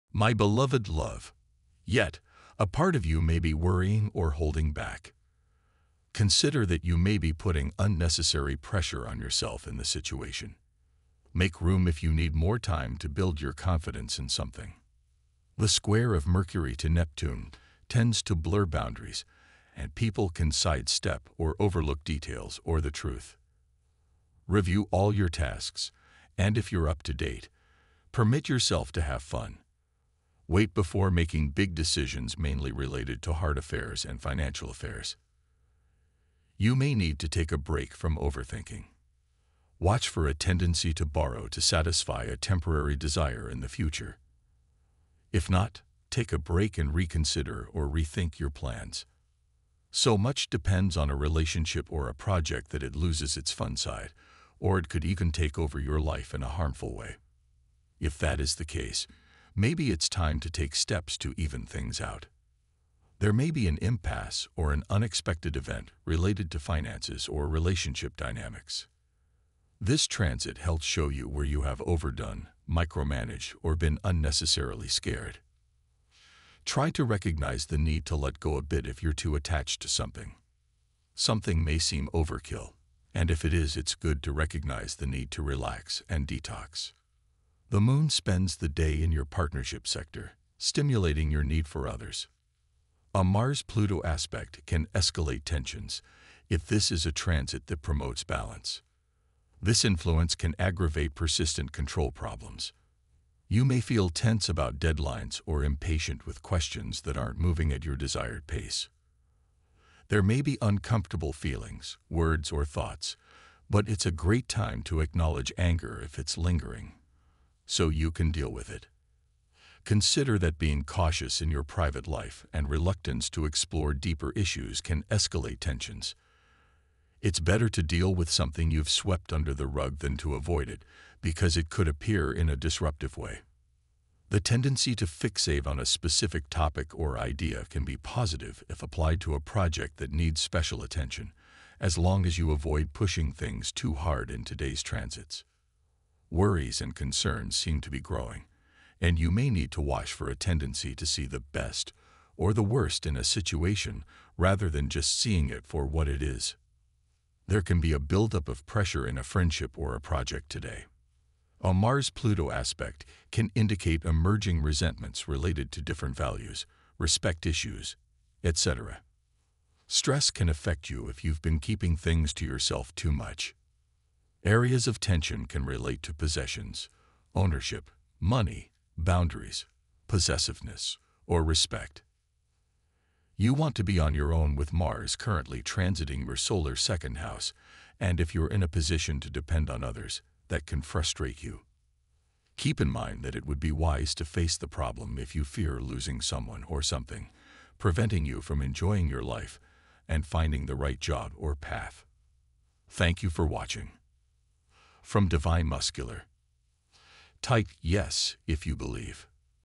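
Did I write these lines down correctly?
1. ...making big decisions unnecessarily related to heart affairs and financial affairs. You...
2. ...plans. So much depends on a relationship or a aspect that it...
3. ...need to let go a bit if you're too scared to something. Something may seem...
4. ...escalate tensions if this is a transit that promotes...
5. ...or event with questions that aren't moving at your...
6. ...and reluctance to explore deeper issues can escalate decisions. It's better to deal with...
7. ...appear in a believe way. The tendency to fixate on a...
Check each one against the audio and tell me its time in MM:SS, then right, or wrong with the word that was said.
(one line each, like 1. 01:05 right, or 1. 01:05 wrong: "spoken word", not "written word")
1. 00:31 wrong: "mainly", not "unnecessarily"
2. 00:48 wrong: "project", not "aspect"
3. 01:17 wrong: "attached", not "scared"
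4. 01:34 right
5. 01:45 wrong: "impatient", not "event"
6. 02:02 wrong: "tensions", not "decisions"
7. 02:11 wrong: "disruptive", not "believe".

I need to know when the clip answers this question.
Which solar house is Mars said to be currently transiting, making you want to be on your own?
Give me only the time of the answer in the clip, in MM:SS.
03:06.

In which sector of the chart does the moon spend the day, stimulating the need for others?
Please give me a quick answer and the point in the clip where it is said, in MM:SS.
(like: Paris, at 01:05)
Partnership sector, at 01:29.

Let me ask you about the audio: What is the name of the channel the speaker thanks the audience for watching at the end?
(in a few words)
Divine Masculine.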